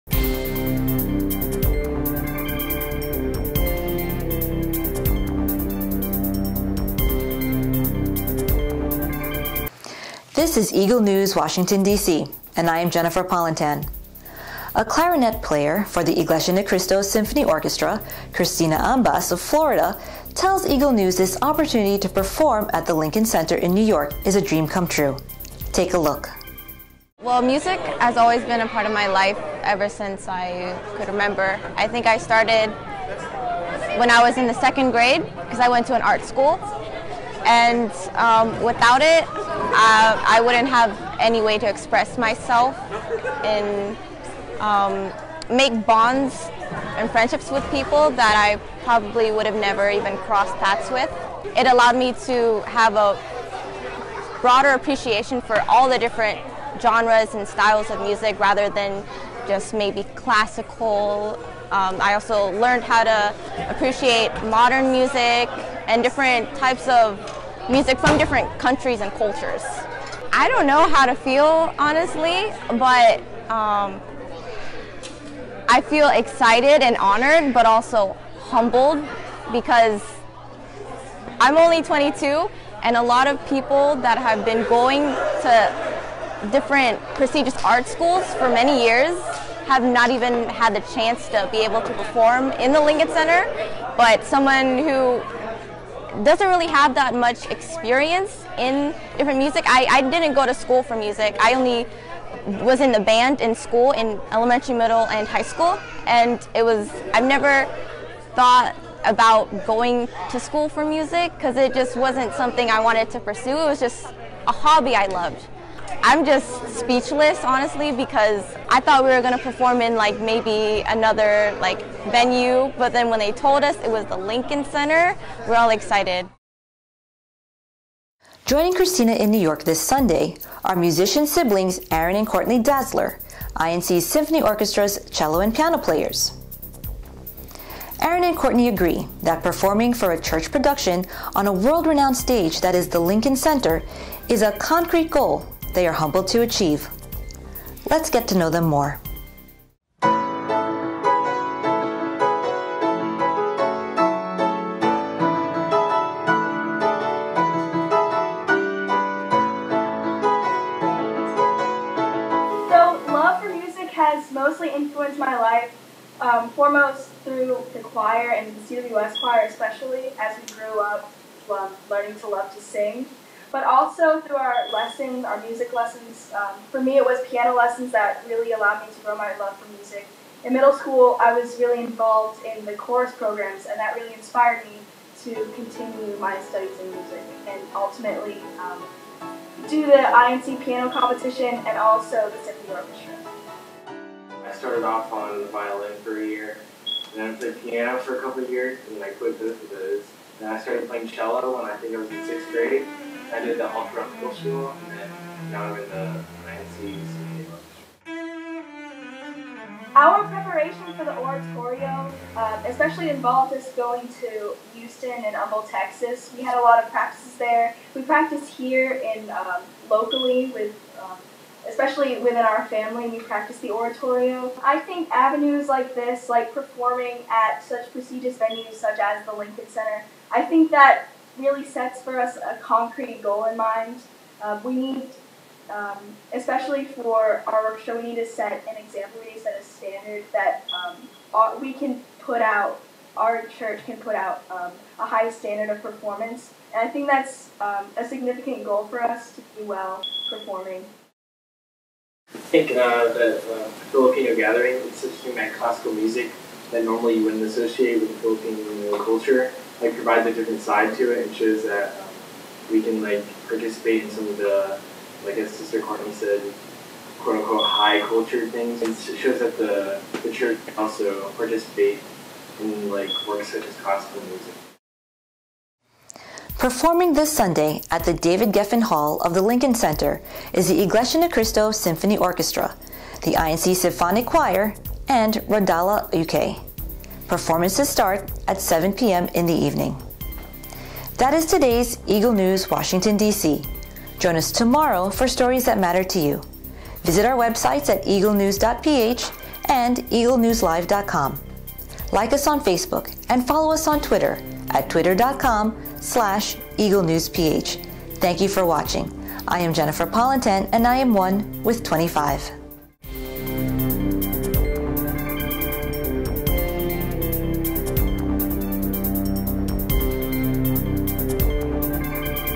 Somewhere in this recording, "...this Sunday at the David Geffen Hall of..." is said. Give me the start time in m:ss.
4:37.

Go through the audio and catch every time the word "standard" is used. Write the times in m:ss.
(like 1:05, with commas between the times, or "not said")
3:59, 4:05.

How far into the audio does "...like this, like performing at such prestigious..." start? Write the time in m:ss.
3:45.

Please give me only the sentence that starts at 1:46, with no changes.
And it was, I've never thought about going to school for music because it just wasn't something I wanted to pursue.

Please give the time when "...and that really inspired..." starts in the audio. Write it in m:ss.
3:03.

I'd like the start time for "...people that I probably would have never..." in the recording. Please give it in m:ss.
0:47.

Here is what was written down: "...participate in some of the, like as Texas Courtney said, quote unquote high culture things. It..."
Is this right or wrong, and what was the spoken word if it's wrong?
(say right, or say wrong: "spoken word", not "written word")
wrong: "Sister", not "Texas".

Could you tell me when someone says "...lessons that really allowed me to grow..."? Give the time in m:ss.
2:57.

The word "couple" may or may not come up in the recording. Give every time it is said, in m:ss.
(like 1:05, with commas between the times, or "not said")
3:18.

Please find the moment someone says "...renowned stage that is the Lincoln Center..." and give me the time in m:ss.
2:21.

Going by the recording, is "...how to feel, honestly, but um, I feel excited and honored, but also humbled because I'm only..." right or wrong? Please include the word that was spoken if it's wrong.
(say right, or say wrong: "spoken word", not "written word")
right.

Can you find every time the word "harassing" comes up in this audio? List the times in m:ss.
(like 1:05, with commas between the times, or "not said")
not said.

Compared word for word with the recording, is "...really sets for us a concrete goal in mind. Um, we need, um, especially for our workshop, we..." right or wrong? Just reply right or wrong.
right.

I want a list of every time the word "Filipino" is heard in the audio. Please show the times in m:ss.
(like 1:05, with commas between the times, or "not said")
4:13, 4:18.